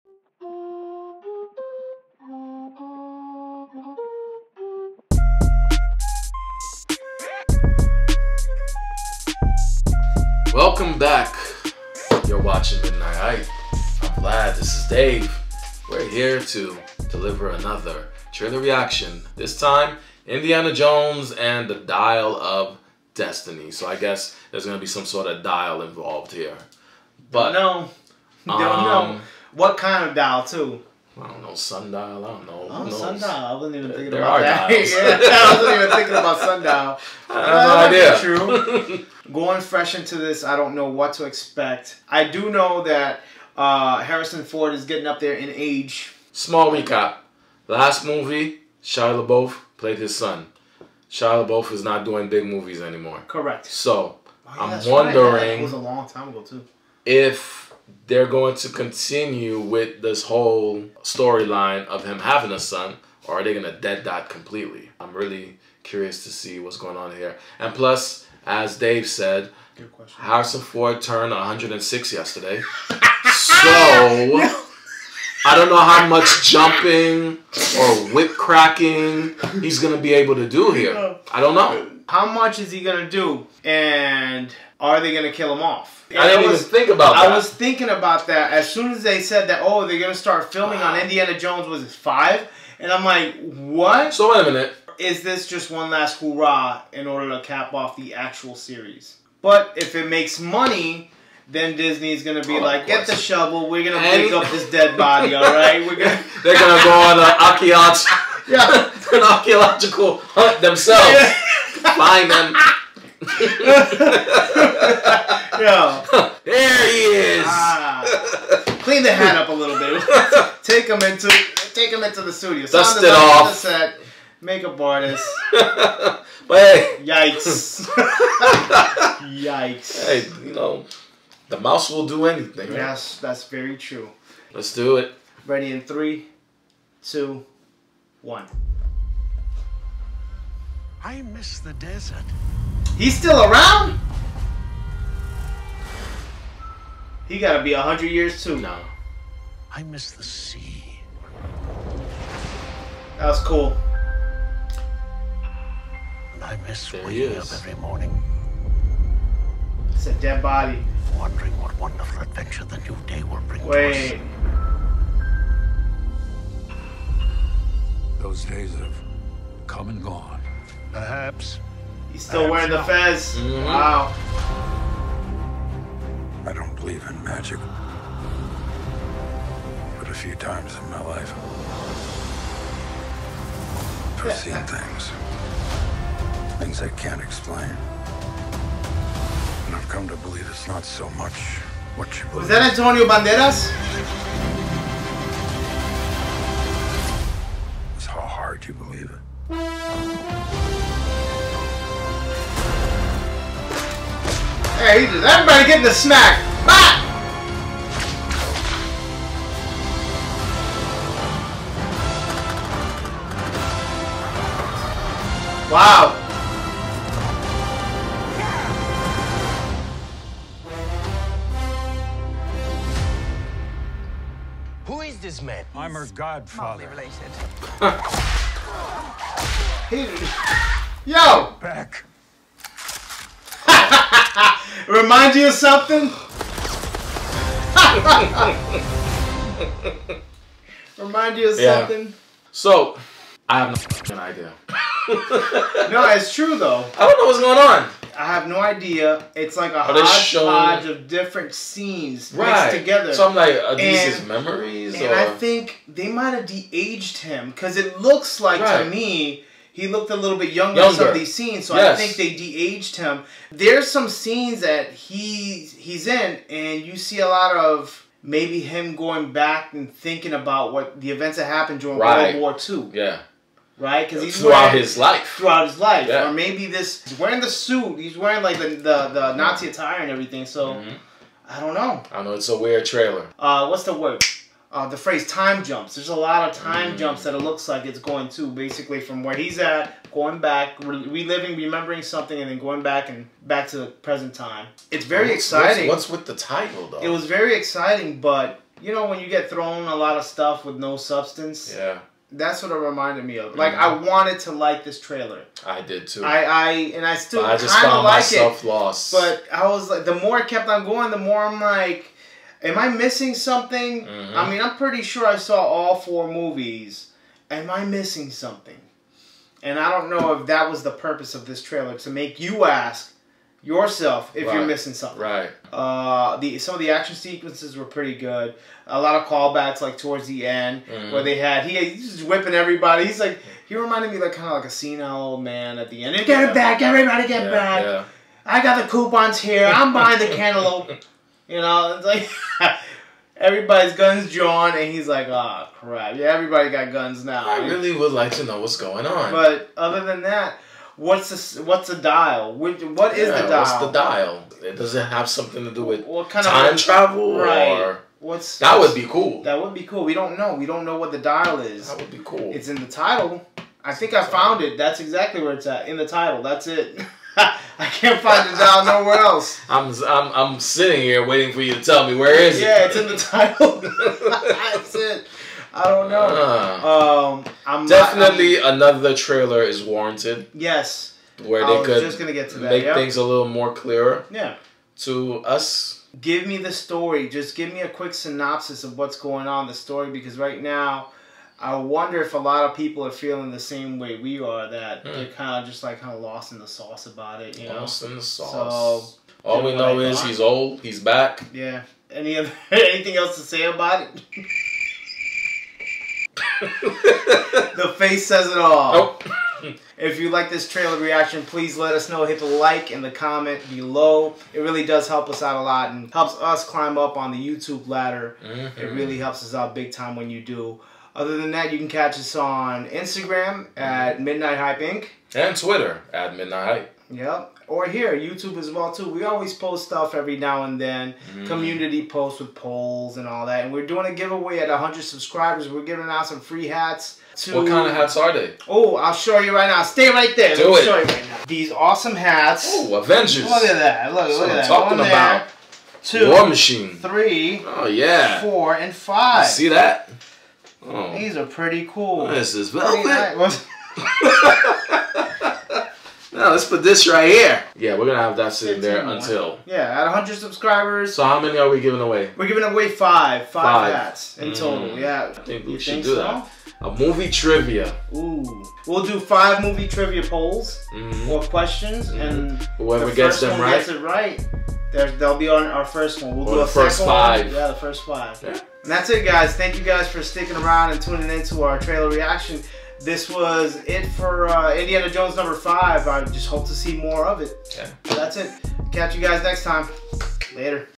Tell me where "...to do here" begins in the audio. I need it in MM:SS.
01:20.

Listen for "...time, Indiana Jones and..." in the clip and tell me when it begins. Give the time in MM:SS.
00:19.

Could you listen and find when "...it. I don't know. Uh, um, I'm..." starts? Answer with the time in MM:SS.
06:14.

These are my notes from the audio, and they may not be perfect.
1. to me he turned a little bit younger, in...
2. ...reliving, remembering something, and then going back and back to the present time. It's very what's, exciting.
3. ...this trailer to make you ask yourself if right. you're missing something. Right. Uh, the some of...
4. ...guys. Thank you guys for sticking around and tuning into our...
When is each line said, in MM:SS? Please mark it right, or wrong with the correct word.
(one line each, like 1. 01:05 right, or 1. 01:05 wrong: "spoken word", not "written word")
1. 04:18 wrong: "looked", not "turned"
2. 04:51 right
3. 05:21 right
4. 07:59 right.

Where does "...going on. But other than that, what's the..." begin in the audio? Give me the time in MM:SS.
05:48.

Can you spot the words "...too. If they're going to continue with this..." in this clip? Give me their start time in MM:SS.
00:56.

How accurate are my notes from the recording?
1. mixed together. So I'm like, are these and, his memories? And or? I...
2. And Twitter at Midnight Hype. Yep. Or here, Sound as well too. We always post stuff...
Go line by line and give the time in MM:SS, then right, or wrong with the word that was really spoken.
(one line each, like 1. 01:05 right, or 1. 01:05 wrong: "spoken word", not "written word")
1. 04:12 right
2. 07:05 wrong: "YouTube", not "Sound".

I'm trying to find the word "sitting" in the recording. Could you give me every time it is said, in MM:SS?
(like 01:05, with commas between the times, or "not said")
06:10, 07:38.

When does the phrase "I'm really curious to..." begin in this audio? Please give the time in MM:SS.
01:04.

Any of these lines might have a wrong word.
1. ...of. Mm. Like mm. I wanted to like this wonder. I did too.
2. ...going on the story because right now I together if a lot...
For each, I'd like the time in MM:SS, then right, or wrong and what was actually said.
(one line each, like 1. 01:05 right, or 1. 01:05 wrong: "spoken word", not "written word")
1. 05:03 wrong: "trailer", not "wonder"
2. 06:29 wrong: "wonder", not "together".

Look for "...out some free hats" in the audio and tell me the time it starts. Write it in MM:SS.
07:16.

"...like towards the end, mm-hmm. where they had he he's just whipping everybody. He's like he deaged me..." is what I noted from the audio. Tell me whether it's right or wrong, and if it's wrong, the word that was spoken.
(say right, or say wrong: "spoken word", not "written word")
wrong: "reminded", not "deaged".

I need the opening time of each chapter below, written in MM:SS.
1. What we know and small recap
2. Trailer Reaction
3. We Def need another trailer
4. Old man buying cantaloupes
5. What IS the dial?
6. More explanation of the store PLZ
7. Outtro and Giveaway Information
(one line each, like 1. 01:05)
1. 00:44
2. 02:18
3. 05:00
4. 05:35
5. 05:50
6. 06:18
7. 06:49.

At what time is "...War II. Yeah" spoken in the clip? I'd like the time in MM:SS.
04:32.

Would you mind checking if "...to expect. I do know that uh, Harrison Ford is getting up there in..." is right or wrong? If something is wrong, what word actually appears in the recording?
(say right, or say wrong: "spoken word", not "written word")
right.